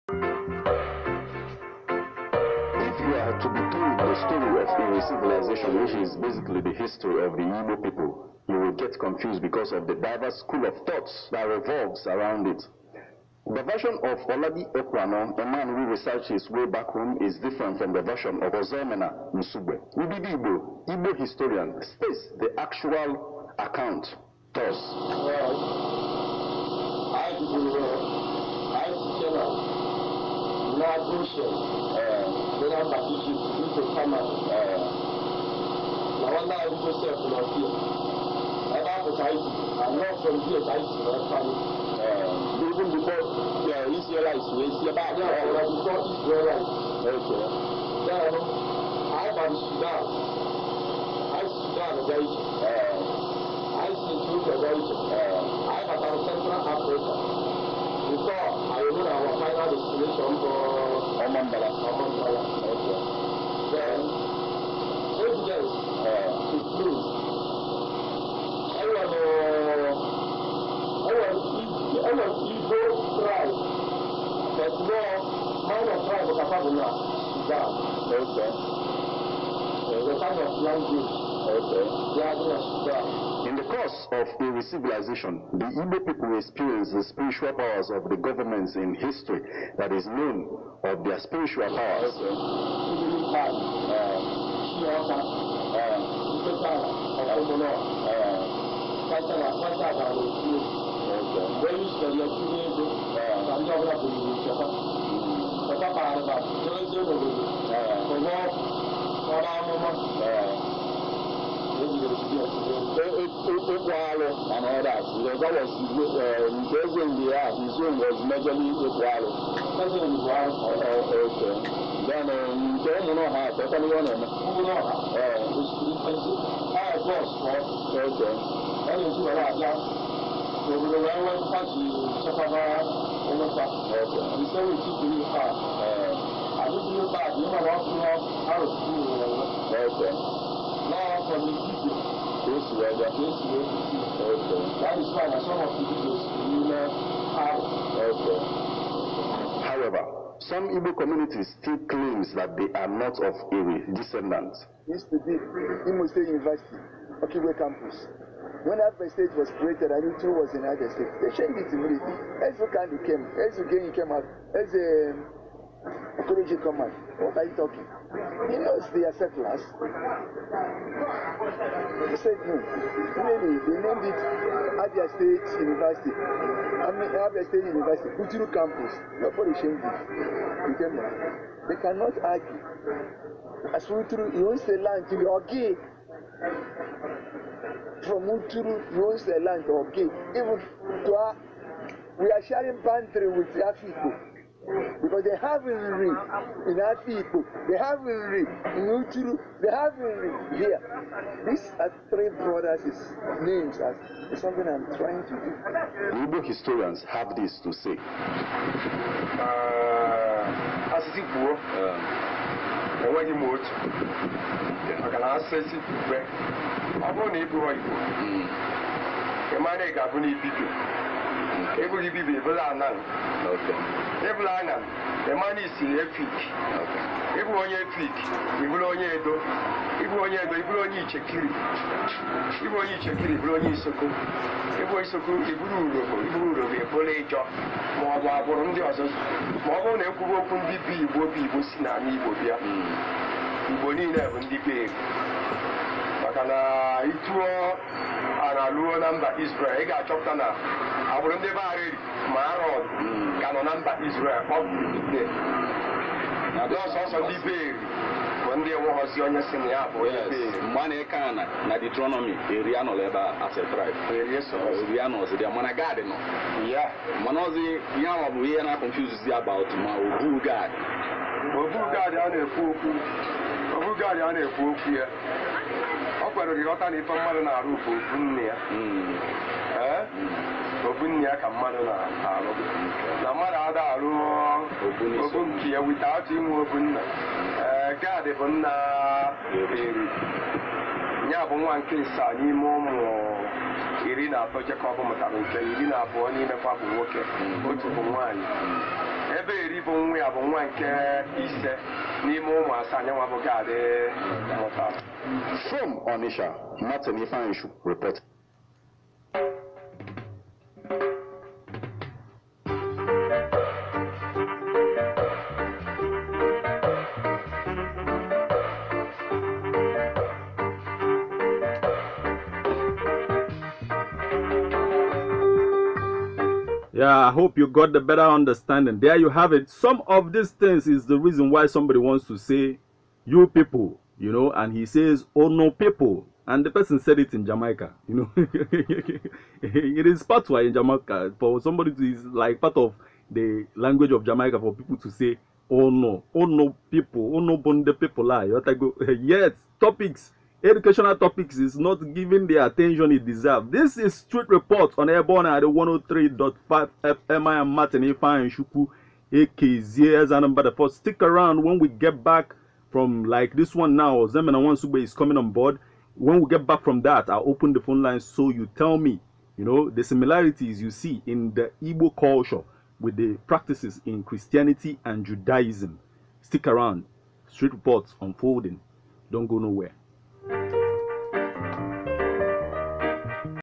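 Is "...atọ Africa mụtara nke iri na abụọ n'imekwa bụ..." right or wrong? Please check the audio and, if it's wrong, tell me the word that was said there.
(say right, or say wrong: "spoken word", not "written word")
wrong: "Jekọb", not "Africa".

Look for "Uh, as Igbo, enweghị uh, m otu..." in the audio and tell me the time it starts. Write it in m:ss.
3:29.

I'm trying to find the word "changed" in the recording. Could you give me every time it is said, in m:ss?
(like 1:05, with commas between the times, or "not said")
2:41, 2:59.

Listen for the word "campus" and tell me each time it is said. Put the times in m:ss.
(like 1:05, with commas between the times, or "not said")
2:37, 2:58.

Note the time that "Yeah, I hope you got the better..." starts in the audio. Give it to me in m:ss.
5:26.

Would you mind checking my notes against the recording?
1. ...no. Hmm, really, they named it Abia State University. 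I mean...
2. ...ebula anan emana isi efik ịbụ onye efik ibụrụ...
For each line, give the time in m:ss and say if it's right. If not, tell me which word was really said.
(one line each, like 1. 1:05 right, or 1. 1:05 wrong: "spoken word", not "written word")
1. 2:52 right
2. 3:44 right.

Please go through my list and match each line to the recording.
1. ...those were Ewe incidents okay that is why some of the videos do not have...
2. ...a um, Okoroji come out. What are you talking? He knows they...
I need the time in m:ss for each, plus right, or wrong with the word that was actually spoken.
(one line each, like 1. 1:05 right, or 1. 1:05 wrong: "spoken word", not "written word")
1. 2:22 wrong: "This", not "Ewe"
2. 2:44 right.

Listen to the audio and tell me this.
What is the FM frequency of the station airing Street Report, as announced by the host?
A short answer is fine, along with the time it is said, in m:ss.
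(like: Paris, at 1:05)
103.5, at 5:55.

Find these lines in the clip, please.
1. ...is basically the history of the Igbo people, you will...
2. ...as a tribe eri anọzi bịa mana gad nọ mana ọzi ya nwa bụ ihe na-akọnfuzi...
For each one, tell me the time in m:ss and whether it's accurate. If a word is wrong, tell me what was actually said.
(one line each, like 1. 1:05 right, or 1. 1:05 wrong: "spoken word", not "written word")
1. 0:05 right
2. 4:23 right.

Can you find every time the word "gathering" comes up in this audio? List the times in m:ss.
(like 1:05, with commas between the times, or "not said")
1:22.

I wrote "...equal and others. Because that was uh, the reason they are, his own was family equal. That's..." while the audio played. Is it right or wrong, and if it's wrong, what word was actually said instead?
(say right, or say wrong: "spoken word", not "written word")
wrong: "majorly", not "family".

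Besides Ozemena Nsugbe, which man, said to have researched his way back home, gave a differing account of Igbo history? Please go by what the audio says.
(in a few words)
Olabi Ekwano.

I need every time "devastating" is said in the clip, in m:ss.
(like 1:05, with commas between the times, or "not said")
not said.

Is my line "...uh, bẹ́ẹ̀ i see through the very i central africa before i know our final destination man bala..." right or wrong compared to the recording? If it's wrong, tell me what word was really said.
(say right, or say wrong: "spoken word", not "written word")
right.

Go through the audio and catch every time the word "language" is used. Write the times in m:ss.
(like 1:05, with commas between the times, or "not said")
1:20, 5:43.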